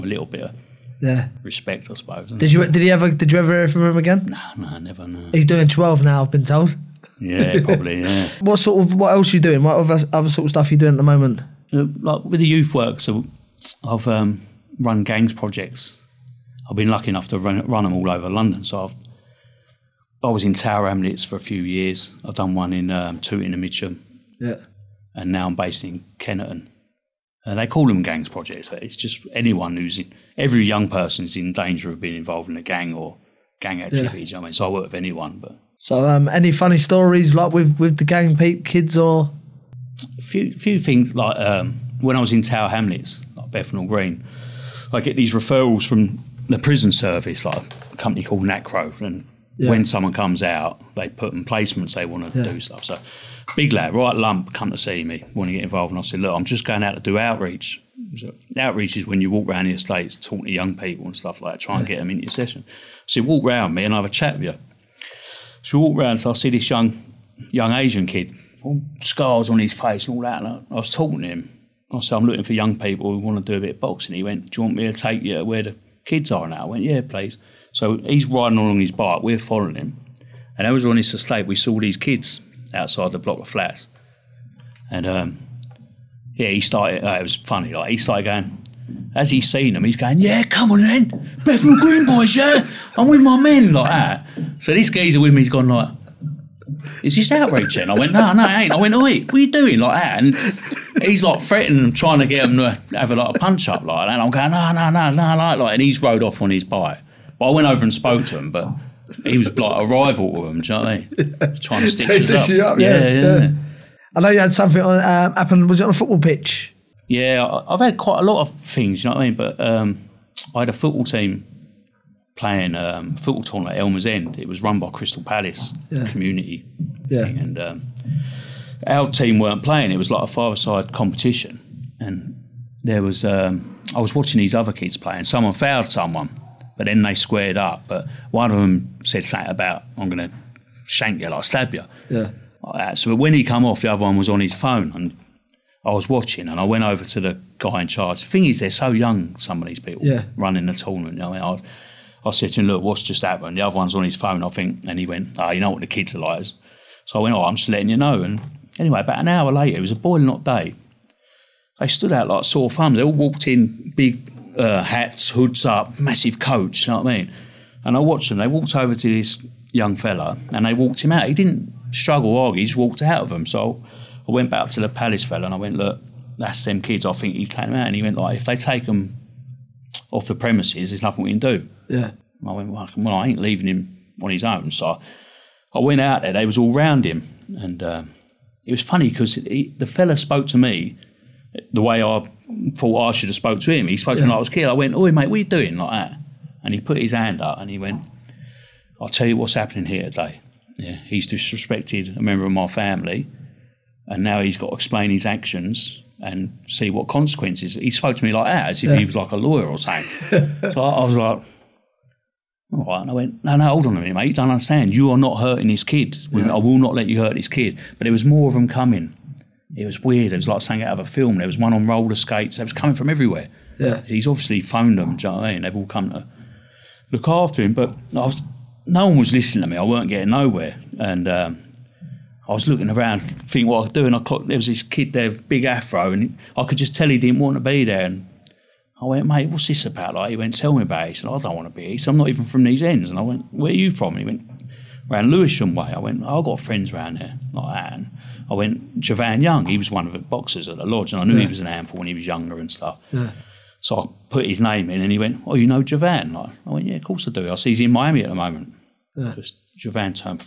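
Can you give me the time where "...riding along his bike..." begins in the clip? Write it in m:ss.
1:18.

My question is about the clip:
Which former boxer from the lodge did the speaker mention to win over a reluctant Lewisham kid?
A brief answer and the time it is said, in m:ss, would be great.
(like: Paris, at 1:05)
Javan Young, at 4:08.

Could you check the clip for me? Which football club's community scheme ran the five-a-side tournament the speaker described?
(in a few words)
Crystal Palace.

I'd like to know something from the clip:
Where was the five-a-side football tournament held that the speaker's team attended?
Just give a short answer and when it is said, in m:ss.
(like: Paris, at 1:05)
Elmers End, at 2:03.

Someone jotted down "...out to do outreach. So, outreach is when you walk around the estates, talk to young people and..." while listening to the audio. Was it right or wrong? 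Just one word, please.
right.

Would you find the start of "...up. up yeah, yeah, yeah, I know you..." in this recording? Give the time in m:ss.
1:52.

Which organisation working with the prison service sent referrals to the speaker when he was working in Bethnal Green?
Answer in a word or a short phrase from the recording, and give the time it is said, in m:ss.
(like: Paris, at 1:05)
Nacro, at 0:48.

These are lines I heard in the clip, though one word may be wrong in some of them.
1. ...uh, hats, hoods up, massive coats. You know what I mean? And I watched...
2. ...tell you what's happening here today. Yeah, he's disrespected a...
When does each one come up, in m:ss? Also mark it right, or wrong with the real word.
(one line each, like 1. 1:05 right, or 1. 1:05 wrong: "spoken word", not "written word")
1. 2:44 right
2. 3:19 right.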